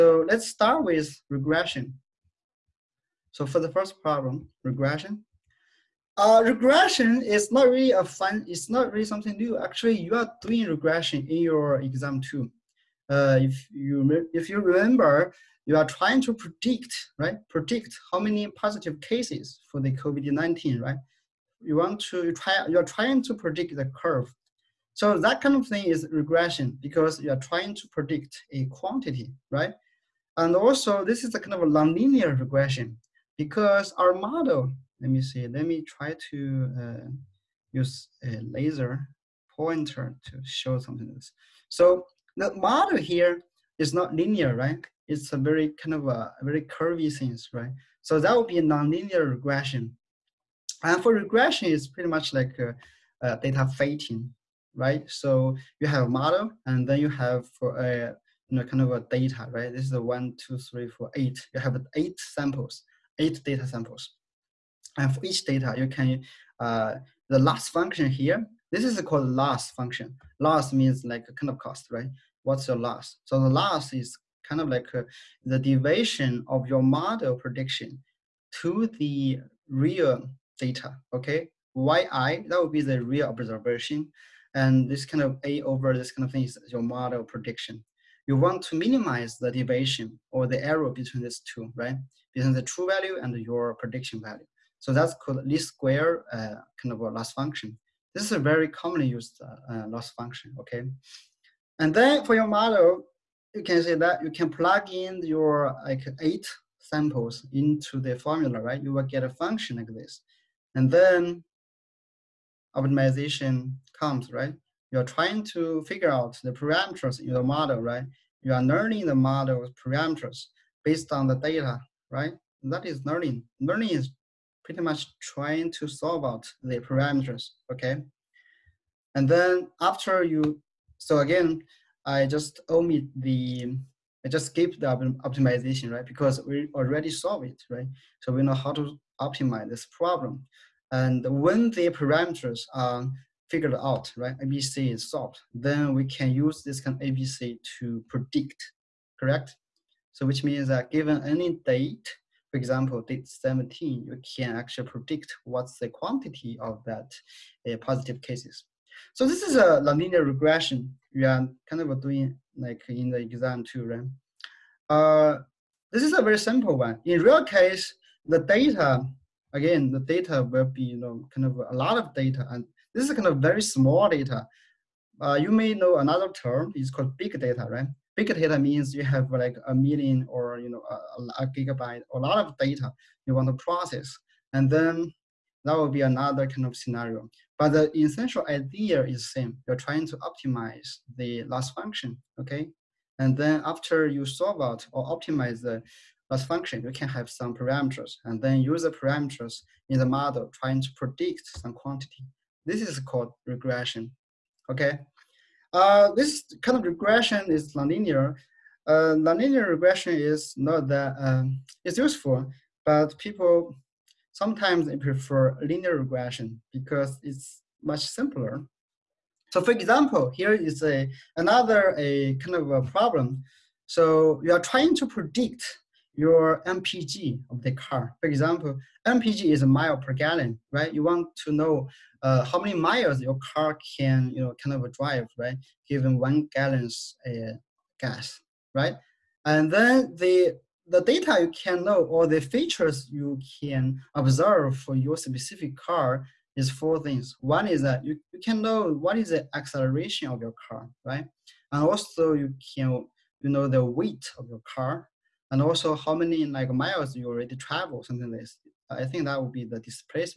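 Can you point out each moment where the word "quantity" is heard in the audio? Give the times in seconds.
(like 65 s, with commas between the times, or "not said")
28 s, 155 s, 201 s.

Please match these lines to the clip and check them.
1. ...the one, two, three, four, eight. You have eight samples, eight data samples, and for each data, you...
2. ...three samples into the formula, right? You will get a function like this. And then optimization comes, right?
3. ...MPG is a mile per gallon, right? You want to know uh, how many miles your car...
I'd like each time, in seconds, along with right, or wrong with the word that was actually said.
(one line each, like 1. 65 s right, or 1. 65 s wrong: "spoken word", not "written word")
1. 59 s right
2. 106 s wrong: "eight", not "three"
3. 229 s right.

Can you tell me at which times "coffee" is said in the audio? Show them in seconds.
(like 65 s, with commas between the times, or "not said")
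not said.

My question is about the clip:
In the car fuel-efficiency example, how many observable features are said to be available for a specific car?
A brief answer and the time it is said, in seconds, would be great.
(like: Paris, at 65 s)
4, at 246 s.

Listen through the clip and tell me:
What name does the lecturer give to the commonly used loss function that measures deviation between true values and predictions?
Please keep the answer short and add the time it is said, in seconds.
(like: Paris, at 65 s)
least square, at 95 s.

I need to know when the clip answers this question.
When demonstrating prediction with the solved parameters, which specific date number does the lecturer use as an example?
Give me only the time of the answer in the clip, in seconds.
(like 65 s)
153 s.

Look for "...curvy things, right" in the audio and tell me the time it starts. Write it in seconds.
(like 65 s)
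46 s.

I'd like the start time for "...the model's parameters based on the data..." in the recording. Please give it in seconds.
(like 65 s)
119 s.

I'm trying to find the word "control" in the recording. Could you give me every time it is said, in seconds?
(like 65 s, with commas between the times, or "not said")
not said.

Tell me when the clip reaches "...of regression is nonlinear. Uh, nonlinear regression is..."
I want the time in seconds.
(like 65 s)
206 s.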